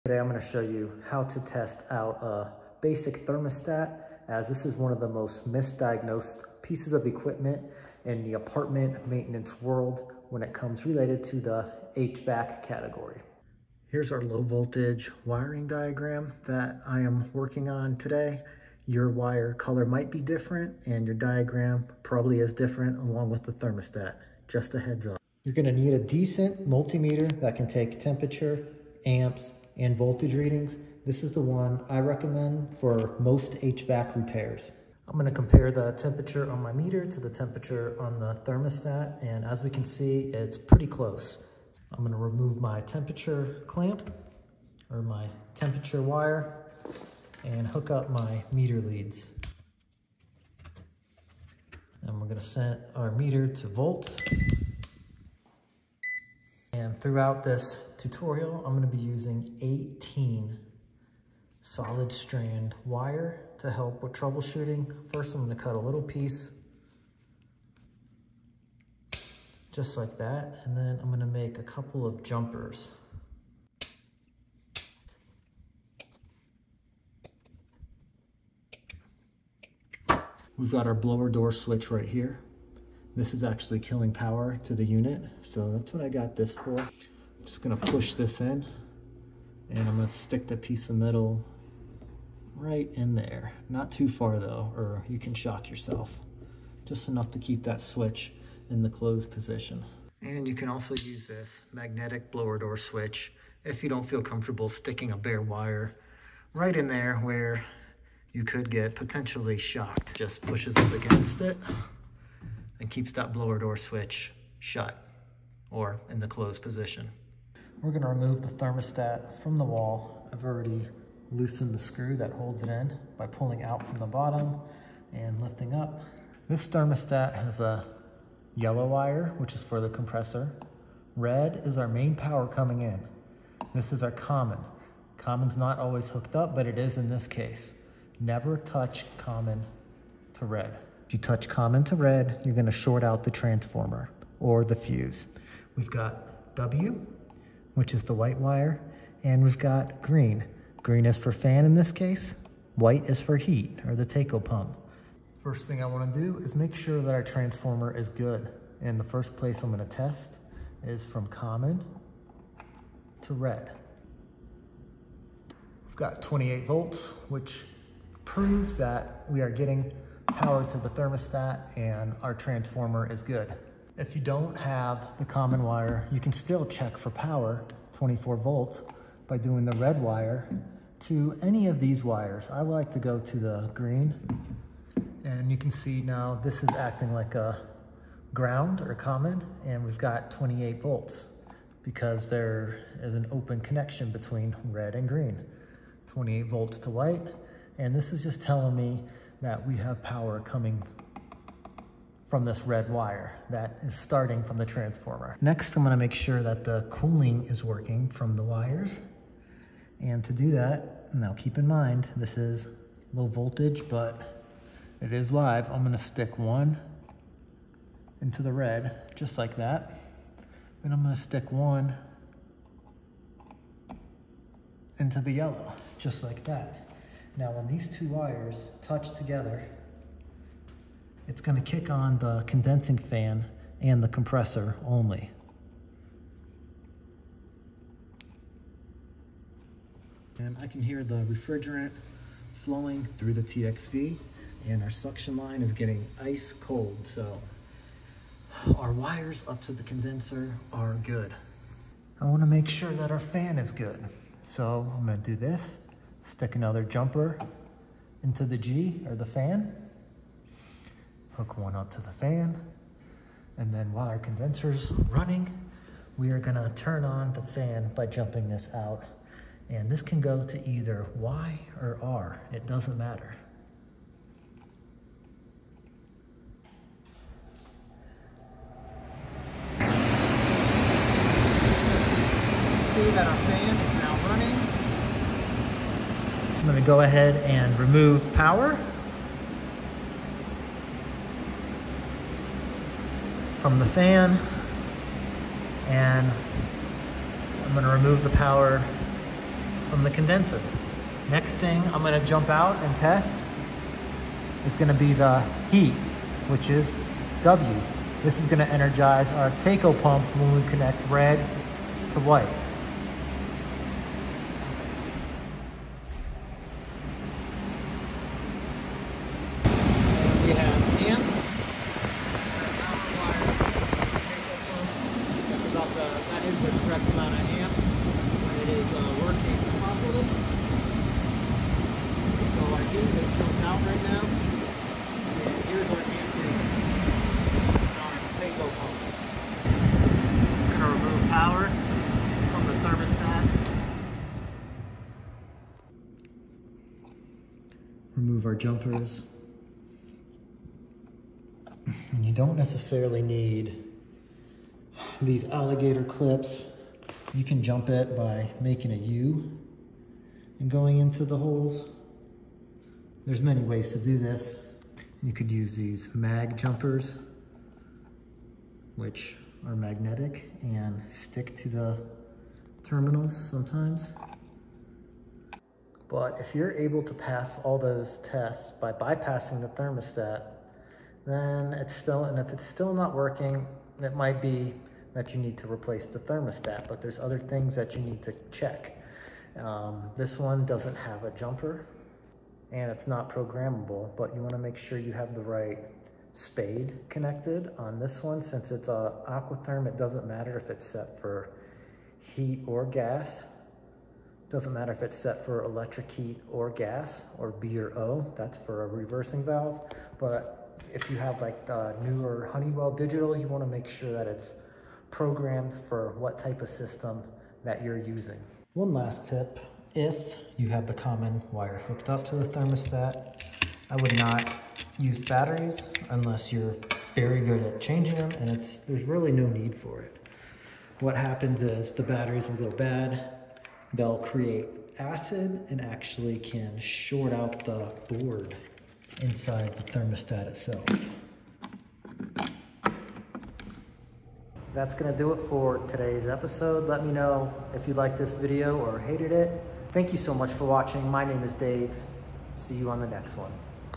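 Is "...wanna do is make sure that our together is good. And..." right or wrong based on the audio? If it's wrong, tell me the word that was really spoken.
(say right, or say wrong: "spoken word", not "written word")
wrong: "transformer", not "together".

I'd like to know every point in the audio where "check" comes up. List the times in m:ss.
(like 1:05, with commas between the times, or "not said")
2:56, 6:28.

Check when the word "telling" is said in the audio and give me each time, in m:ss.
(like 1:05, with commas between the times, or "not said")
3:18.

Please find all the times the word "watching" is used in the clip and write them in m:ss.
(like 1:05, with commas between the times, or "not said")
7:30.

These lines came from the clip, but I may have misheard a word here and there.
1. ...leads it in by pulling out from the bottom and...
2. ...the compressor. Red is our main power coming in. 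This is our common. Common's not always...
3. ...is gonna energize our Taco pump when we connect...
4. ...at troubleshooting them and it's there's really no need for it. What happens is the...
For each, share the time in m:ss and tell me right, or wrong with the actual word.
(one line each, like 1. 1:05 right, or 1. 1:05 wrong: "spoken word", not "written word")
1. 2:02 wrong: "holds", not "leads"
2. 2:09 right
3. 5:08 right
4. 7:07 wrong: "changing", not "troubleshooting".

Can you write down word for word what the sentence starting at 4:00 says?
And I can hear the refrigerant flowing through the TXV and our suction line is getting ice cold.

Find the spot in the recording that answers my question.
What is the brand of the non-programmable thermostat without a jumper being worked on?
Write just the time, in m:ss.
6:39.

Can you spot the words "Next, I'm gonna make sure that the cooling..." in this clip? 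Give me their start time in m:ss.
3:25.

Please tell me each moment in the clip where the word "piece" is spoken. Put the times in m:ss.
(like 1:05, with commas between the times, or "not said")
0:06, 1:06, 1:30.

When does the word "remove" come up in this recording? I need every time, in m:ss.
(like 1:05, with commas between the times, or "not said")
0:42, 1:58, 4:47, 4:57, 5:40, 5:48.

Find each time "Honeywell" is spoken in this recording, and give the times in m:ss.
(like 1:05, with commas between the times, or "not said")
6:52.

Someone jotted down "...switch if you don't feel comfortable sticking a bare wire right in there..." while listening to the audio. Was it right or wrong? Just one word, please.
right.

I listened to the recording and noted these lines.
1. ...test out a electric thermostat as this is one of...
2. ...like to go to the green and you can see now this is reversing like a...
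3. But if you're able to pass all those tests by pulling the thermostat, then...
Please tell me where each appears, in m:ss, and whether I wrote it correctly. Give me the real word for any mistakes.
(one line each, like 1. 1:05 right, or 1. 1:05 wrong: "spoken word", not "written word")
1. 0:01 wrong: "basic", not "electric"
2. 3:02 wrong: "acting", not "reversing"
3. 6:16 wrong: "bypassing", not "pulling".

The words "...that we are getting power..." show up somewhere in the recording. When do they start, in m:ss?
2:48.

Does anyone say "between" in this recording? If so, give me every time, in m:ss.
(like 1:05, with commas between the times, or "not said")
3:14.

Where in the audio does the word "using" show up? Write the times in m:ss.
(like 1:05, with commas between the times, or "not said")
0:58, 6:57.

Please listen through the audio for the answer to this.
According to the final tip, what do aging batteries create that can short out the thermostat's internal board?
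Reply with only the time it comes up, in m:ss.
7:14.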